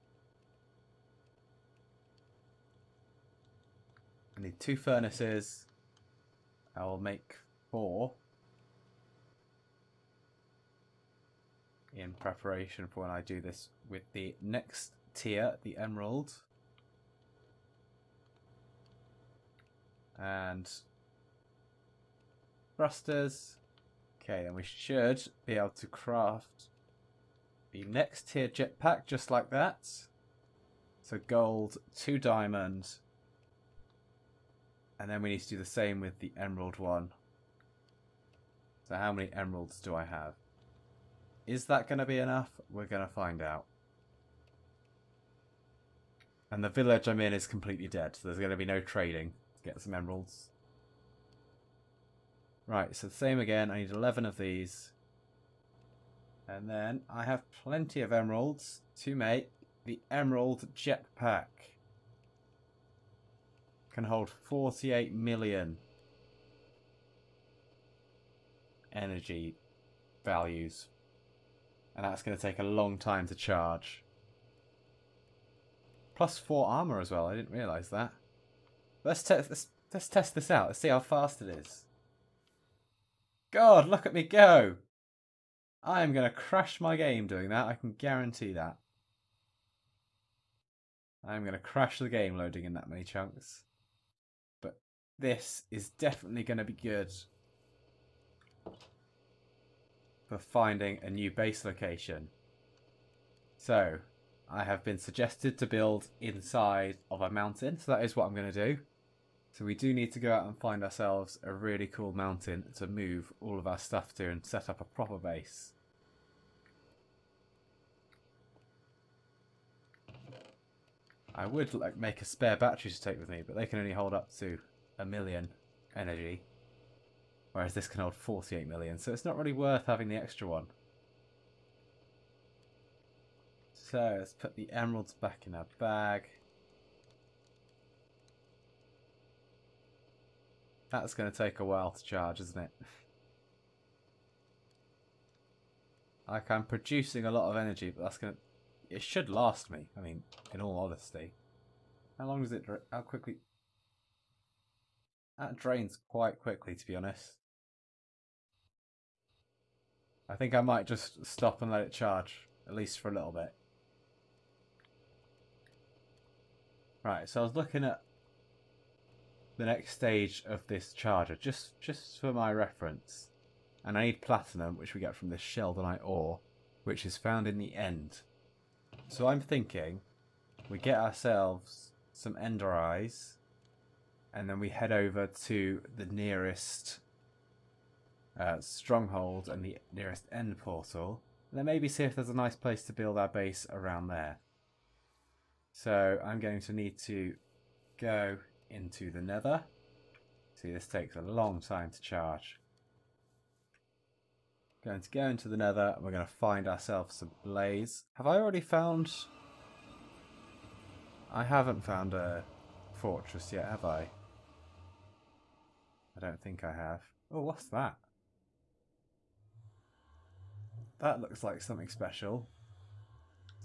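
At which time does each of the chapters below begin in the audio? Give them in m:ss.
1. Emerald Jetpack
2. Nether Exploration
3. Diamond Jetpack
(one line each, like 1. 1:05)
1. 0:55
2. 2:44
3. 0:23.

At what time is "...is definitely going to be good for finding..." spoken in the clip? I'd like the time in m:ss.
1:35.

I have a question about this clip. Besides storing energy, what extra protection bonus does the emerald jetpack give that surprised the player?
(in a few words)
4 armor.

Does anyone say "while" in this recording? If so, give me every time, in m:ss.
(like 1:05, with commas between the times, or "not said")
2:21.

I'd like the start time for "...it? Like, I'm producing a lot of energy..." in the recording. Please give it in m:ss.
2:22.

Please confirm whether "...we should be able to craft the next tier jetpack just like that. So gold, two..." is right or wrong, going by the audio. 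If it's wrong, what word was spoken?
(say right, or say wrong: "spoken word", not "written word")
right.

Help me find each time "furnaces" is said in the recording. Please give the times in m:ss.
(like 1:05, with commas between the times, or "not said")
0:04.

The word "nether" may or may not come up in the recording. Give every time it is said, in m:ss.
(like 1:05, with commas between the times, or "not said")
3:19, 3:25.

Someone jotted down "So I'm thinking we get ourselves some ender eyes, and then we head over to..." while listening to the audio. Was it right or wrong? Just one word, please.
right.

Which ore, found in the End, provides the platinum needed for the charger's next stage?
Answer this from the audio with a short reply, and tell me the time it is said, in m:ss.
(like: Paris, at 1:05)
Sheldonite, at 2:55.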